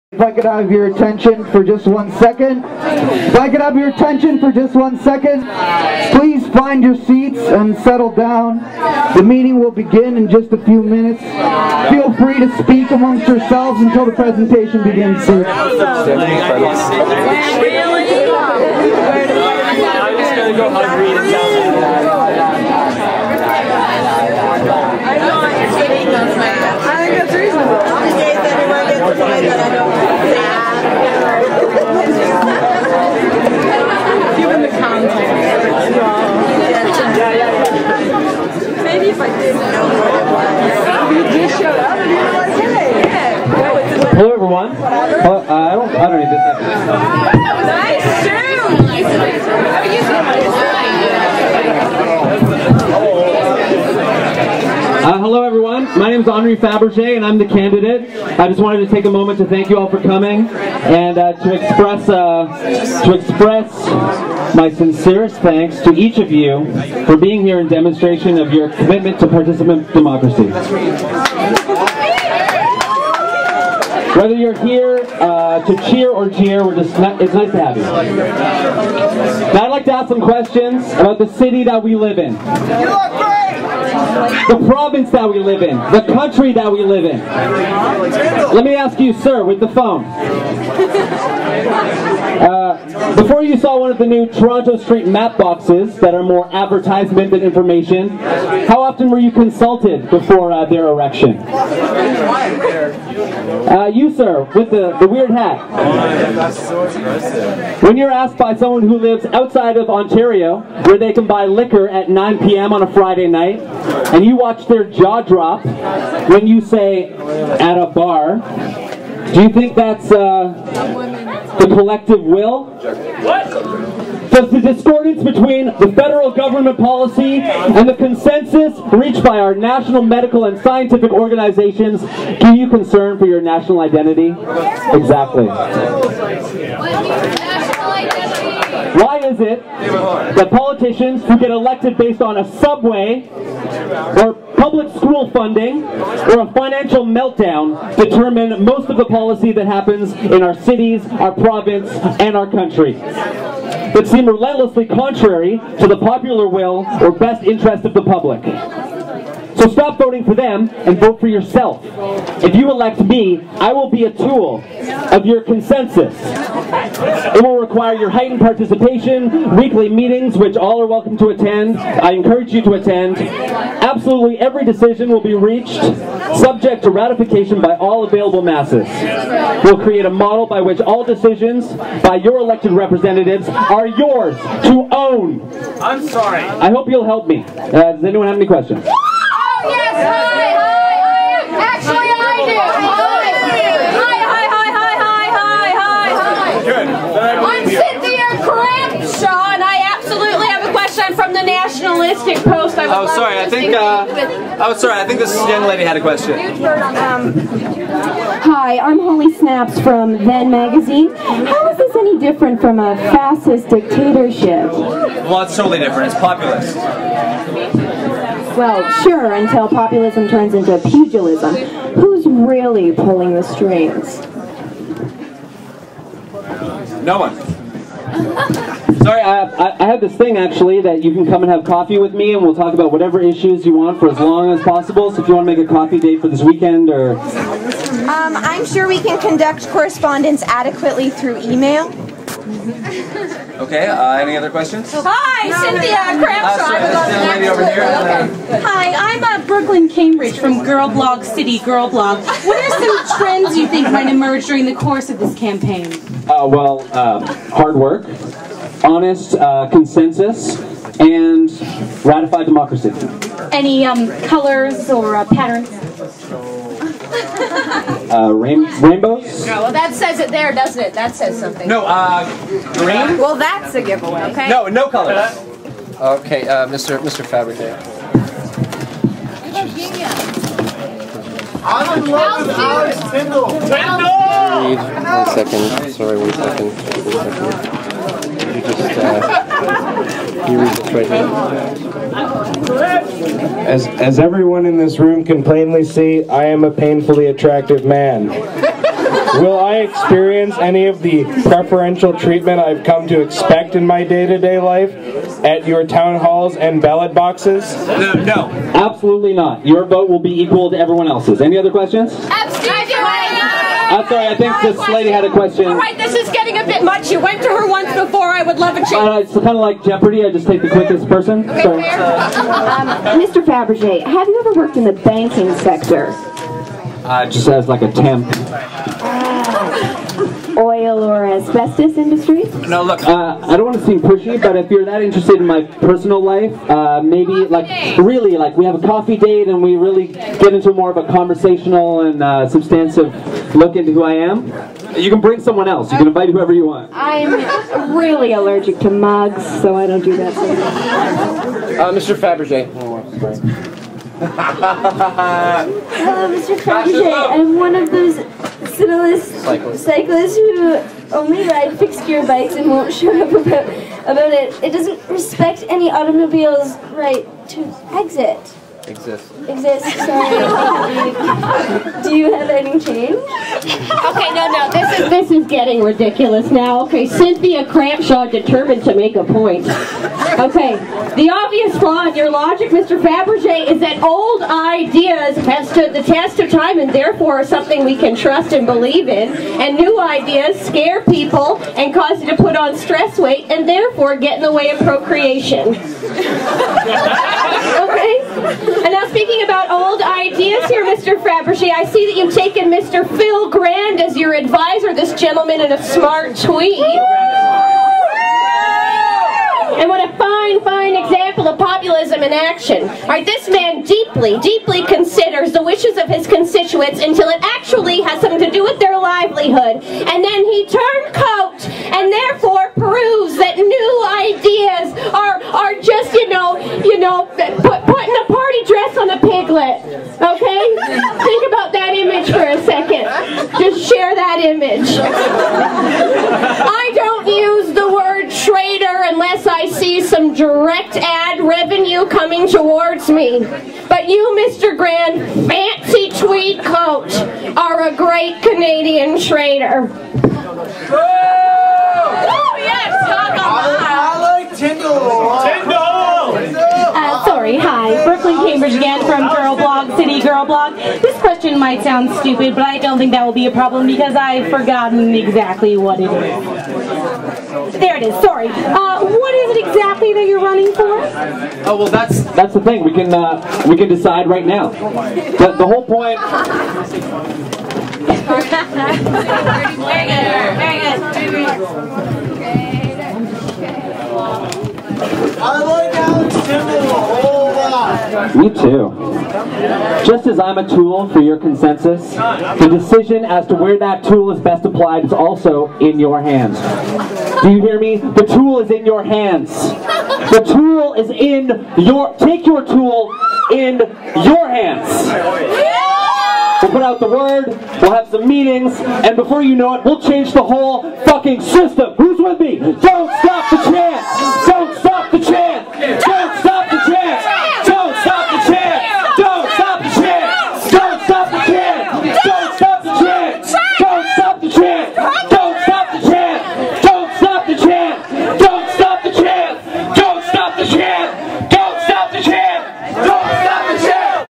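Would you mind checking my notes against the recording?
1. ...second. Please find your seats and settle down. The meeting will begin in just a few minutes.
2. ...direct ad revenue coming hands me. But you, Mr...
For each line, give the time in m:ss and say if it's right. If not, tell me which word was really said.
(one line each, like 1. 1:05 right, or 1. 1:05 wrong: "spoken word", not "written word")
1. 0:04 right
2. 7:20 wrong: "towards", not "hands".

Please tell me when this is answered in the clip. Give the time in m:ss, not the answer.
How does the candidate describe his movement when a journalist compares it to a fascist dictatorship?
3:36.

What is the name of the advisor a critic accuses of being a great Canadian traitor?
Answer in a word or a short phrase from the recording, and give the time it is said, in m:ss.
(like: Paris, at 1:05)
Phil Grand, at 6:43.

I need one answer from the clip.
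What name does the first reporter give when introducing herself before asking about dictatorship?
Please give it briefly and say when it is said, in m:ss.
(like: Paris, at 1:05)
Holly Snaps, at 3:28.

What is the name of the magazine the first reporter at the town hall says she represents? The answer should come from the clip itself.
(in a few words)
Then Magazine.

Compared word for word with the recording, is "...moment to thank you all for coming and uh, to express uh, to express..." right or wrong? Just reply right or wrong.
right.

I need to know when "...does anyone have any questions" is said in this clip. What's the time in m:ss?
3:07.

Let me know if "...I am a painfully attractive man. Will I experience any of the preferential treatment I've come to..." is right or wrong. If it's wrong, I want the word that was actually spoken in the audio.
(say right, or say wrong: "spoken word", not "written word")
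right.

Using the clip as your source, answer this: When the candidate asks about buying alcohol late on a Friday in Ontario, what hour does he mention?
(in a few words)
9 p.m.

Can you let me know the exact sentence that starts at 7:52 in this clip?
We can, uh, we can decide right now.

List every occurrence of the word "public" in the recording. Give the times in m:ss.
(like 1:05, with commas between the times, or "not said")
2:24, 2:38.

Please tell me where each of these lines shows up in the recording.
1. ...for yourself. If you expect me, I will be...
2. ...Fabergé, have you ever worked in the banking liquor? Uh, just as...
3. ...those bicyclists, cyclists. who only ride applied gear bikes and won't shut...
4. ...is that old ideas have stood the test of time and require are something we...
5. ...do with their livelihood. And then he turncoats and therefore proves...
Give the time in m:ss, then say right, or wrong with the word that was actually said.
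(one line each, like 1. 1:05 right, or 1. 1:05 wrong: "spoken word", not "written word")
1. 2:41 wrong: "elect", not "expect"
2. 5:23 wrong: "sector", not "liquor"
3. 5:57 wrong: "fixed", not "applied"
4. 6:23 wrong: "therefore", not "require"
5. 6:58 right.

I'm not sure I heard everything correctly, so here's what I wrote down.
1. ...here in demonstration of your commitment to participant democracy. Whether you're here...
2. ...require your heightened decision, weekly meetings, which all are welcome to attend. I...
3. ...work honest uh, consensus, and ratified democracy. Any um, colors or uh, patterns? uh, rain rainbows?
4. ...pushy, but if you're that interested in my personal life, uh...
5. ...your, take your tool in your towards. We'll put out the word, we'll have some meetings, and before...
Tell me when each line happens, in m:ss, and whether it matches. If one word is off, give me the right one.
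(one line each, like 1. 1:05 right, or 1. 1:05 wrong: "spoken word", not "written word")
1. 1:07 right
2. 2:47 wrong: "participation", not "decision"
3. 4:17 right
4. 5:33 right
5. 8:21 wrong: "hands", not "towards".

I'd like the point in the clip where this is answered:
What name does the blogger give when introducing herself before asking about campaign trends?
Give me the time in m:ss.
4:09.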